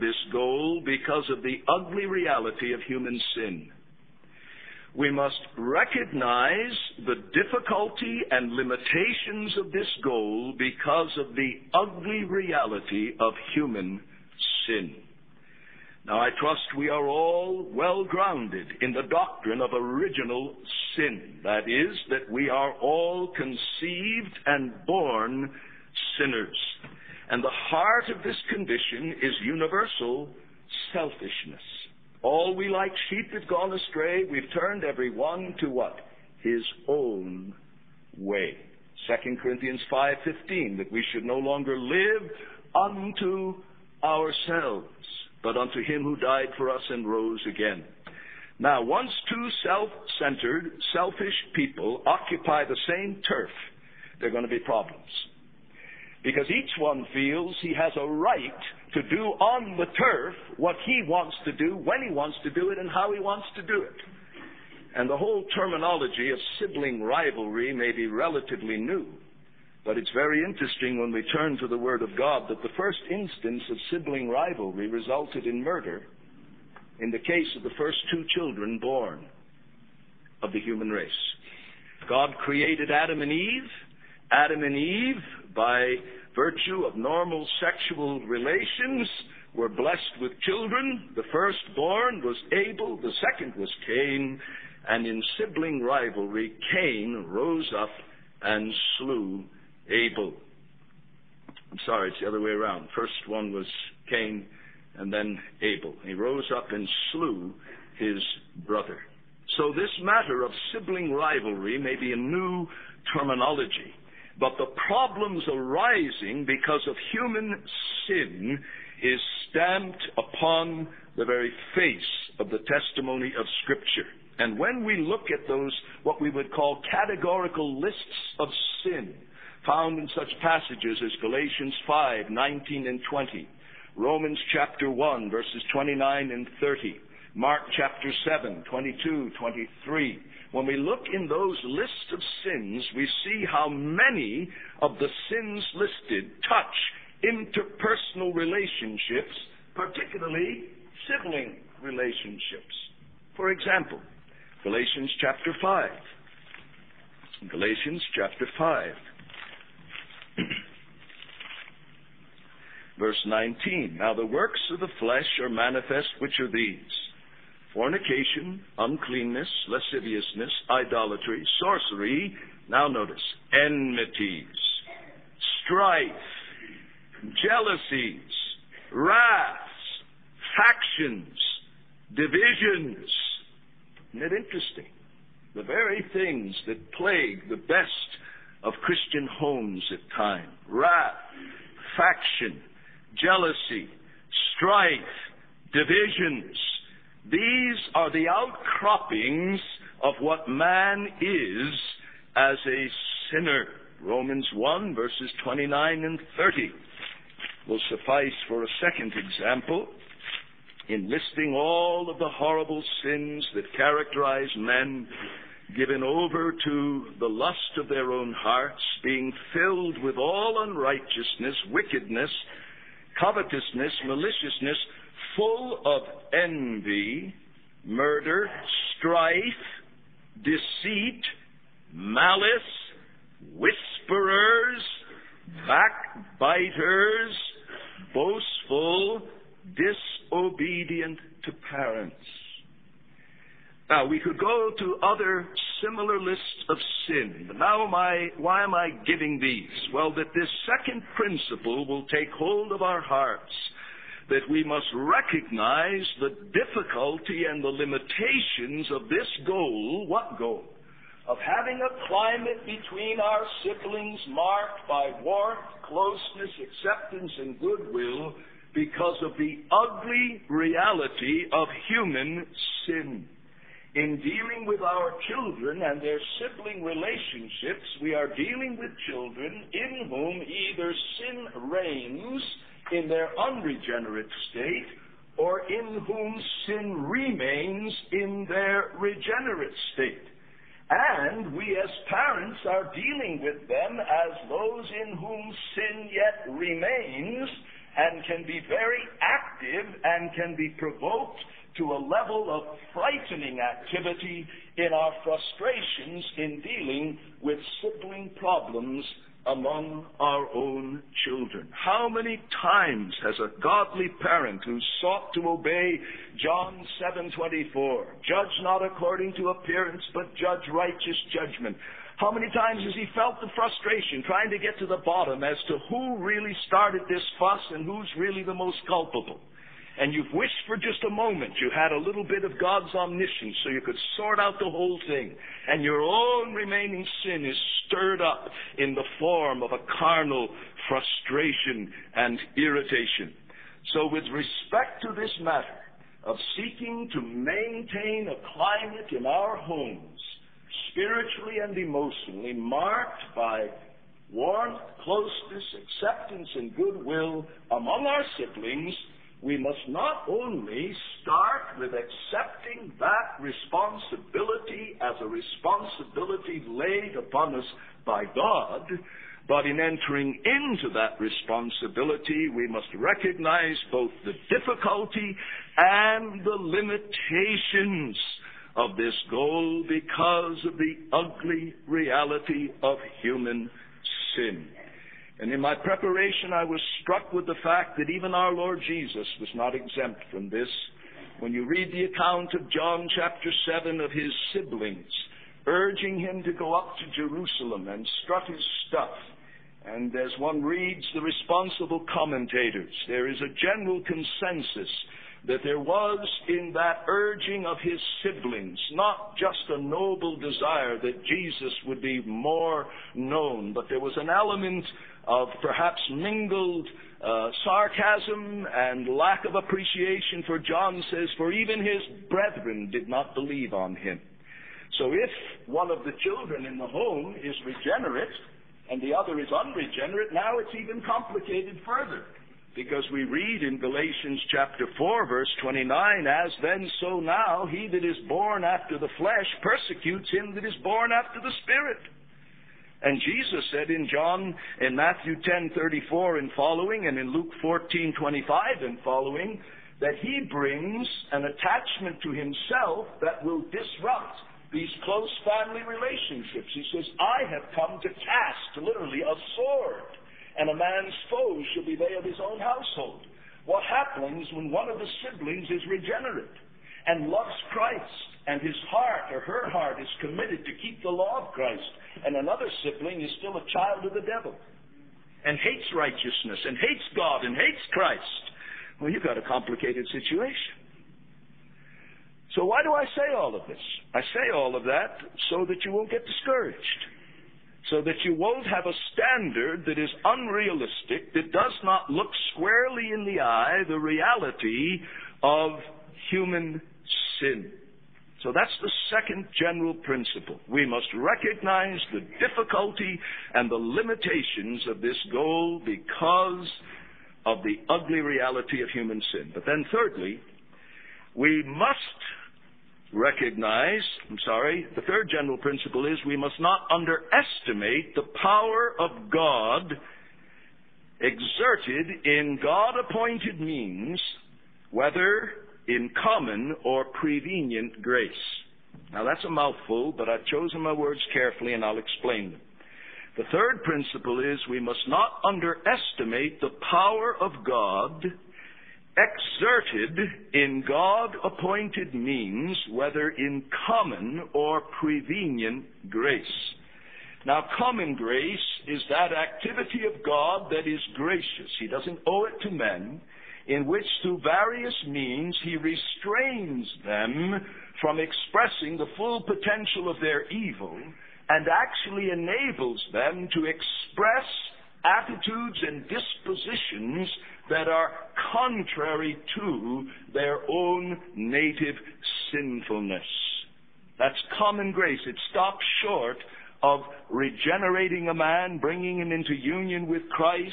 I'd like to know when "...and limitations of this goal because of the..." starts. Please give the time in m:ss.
0:08.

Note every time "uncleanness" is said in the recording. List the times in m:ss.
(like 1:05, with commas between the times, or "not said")
2:48.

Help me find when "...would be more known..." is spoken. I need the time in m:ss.
6:51.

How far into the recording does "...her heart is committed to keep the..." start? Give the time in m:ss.
7:49.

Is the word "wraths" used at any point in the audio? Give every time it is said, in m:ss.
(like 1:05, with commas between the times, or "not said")
2:58, 3:10.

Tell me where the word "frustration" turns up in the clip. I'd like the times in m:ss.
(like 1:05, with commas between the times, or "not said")
5:05, 5:23, 5:40.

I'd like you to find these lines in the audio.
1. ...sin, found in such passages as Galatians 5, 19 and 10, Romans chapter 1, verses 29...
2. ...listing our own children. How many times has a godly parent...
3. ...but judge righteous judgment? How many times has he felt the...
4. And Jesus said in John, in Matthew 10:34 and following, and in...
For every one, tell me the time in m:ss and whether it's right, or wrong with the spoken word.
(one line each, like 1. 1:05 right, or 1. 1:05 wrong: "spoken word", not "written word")
1. 2:08 wrong: "20", not "10"
2. 5:09 wrong: "among", not "listing"
3. 5:20 right
4. 7:23 right.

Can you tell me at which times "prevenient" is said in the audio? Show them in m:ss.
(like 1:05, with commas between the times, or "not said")
8:47, 9:05.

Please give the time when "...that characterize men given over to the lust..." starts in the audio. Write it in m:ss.
3:33.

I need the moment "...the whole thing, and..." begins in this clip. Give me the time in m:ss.
5:34.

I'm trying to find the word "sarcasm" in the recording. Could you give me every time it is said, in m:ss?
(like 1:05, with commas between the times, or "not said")
6:57.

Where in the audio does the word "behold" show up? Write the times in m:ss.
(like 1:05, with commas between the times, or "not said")
not said.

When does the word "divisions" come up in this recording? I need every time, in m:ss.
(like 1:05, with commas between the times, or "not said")
3:02, 3:15.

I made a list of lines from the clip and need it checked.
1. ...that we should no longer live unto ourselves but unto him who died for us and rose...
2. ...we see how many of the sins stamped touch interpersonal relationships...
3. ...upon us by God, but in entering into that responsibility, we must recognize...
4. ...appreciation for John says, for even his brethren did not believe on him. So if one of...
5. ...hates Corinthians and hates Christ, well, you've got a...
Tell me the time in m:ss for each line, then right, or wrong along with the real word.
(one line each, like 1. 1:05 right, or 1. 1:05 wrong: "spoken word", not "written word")
1. 0:40 right
2. 2:22 wrong: "listed", not "stamped"
3. 6:07 right
4. 6:59 right
5. 7:56 wrong: "God", not "Corinthians".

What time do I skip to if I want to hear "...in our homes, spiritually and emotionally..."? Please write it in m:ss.
5:49.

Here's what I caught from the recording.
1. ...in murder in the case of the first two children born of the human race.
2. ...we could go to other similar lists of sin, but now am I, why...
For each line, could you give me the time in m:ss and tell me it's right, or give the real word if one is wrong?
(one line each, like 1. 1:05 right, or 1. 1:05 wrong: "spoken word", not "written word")
1. 1:15 right
2. 4:04 right.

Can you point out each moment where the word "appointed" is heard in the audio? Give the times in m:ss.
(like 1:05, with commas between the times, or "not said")
8:43, 9:01.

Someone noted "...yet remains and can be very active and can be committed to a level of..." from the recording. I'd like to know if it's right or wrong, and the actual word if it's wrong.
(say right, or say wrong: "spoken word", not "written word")
wrong: "provoked", not "committed".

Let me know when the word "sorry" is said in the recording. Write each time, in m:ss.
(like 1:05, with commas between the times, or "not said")
1:41, 8:34.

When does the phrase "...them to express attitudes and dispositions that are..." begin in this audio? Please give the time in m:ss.
9:23.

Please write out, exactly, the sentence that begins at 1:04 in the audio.
And the whole terminology of sibling rivalry may be relatively new.